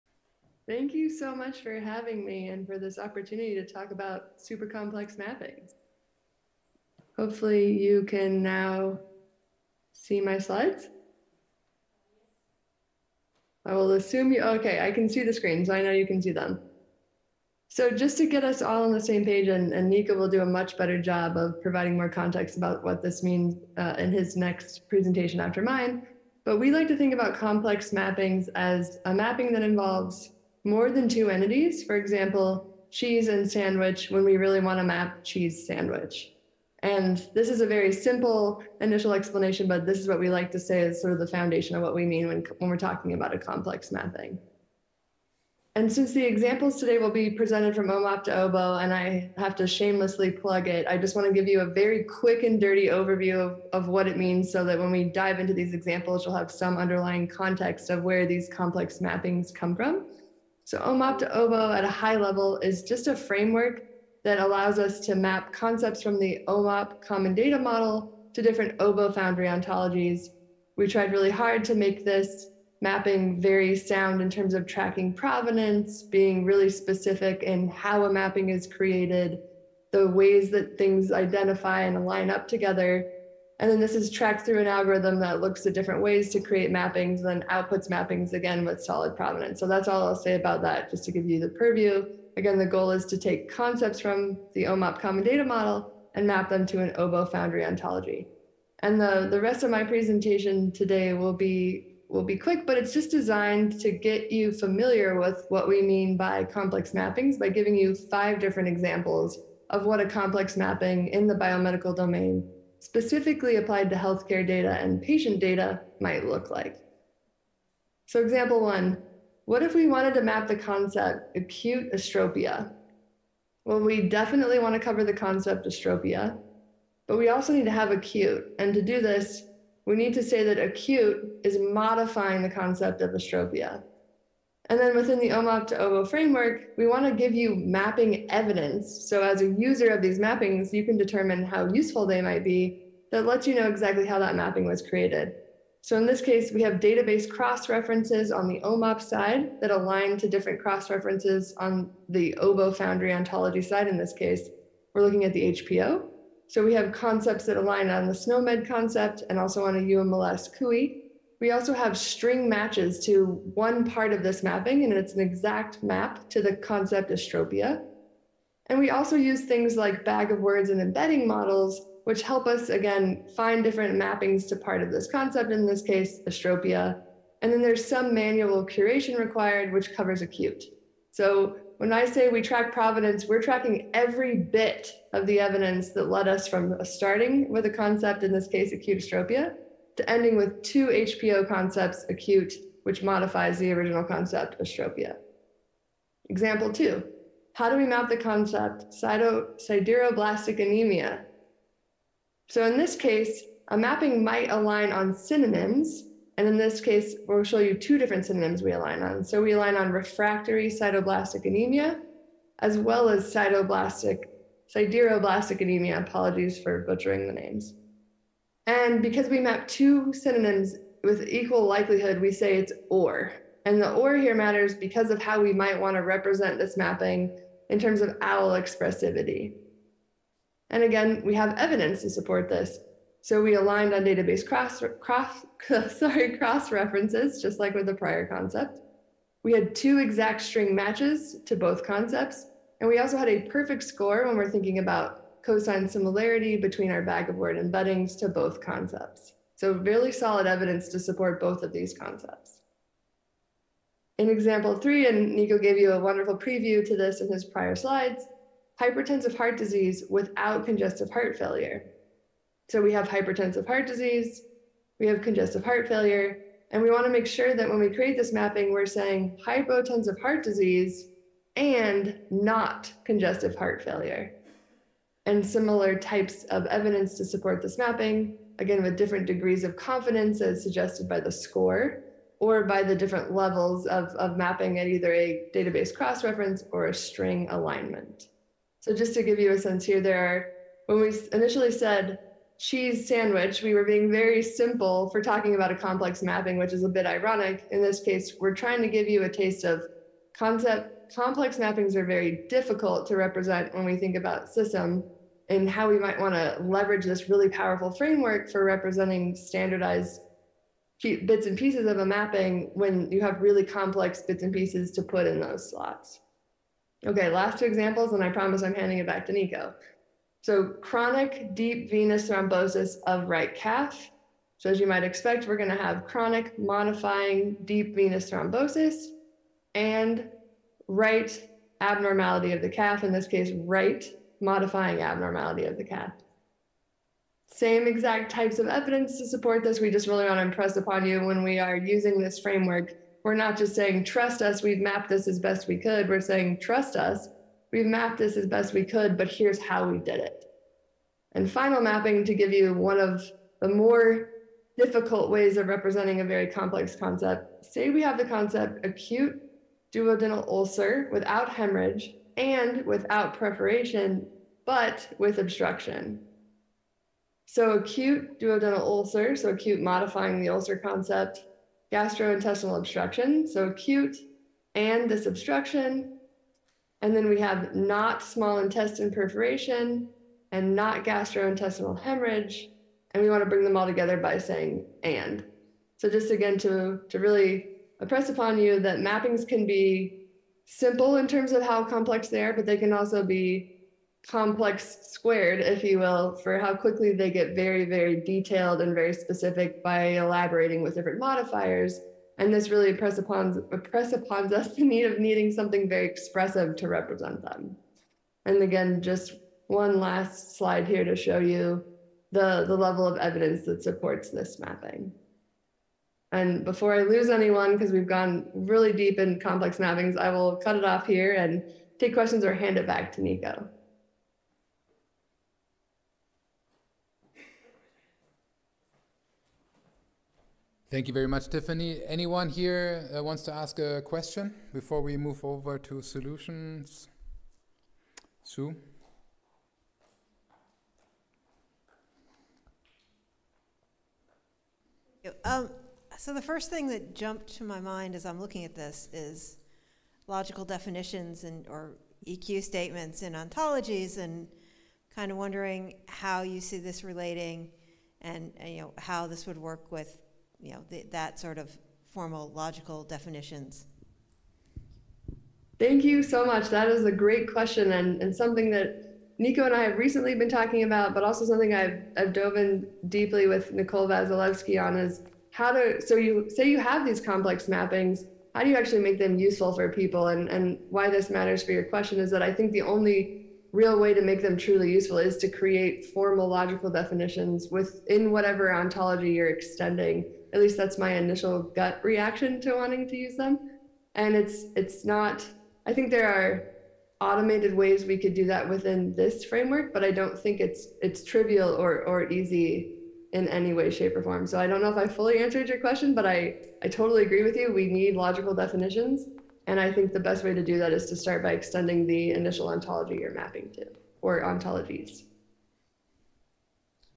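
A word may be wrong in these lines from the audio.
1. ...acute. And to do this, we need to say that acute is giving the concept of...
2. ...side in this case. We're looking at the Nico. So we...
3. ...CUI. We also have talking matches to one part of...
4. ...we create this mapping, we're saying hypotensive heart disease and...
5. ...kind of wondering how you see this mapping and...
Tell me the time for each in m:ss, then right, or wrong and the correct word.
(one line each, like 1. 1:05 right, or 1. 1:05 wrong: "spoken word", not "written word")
1. 2:07 wrong: "modifying", not "giving"
2. 2:33 wrong: "HPO", not "Nico"
3. 2:40 wrong: "string", not "talking"
4. 4:27 right
5. 7:35 wrong: "relating", not "mapping".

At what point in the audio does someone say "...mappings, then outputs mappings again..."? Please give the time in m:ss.
1:26.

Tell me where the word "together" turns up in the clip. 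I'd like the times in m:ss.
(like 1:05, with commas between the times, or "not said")
1:22, 6:23.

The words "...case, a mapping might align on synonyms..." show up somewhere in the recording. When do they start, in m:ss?
3:22.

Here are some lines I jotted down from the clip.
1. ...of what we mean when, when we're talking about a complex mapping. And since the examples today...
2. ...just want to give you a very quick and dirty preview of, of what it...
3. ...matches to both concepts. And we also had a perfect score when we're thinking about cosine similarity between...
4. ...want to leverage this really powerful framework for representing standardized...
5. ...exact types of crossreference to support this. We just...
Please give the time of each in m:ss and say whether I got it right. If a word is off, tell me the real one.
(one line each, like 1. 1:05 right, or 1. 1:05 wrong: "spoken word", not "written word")
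1. 0:41 right
2. 0:50 wrong: "overview", not "preview"
3. 4:00 right
4. 5:06 right
5. 5:37 wrong: "evidence", not "crossreference".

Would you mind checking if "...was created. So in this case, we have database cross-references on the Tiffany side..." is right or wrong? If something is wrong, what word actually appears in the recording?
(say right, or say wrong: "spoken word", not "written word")
wrong: "OMOP", not "Tiffany".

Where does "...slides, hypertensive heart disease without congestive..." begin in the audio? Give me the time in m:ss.
4:17.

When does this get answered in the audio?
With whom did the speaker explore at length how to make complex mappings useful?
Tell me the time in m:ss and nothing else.
7:53.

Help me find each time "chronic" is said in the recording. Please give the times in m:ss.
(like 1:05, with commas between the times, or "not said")
5:20, 5:26.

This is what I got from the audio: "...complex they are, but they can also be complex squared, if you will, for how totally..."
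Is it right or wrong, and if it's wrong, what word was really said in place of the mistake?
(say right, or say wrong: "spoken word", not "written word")
wrong: "quickly", not "totally".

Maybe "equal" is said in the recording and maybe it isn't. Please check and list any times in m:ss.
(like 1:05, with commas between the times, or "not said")
3:41.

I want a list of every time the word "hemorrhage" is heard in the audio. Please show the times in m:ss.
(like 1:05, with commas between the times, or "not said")
6:01, 6:21.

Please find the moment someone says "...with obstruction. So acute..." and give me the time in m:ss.
6:05.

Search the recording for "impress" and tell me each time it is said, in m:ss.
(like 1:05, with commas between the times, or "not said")
5:40, 6:27.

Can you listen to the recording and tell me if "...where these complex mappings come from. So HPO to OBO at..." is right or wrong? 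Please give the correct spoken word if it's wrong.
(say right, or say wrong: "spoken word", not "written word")
wrong: "OMOP", not "HPO".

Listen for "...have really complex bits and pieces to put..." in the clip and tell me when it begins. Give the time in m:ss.
5:13.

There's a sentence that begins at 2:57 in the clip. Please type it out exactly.
And then there's some manual curation required, which covers acute.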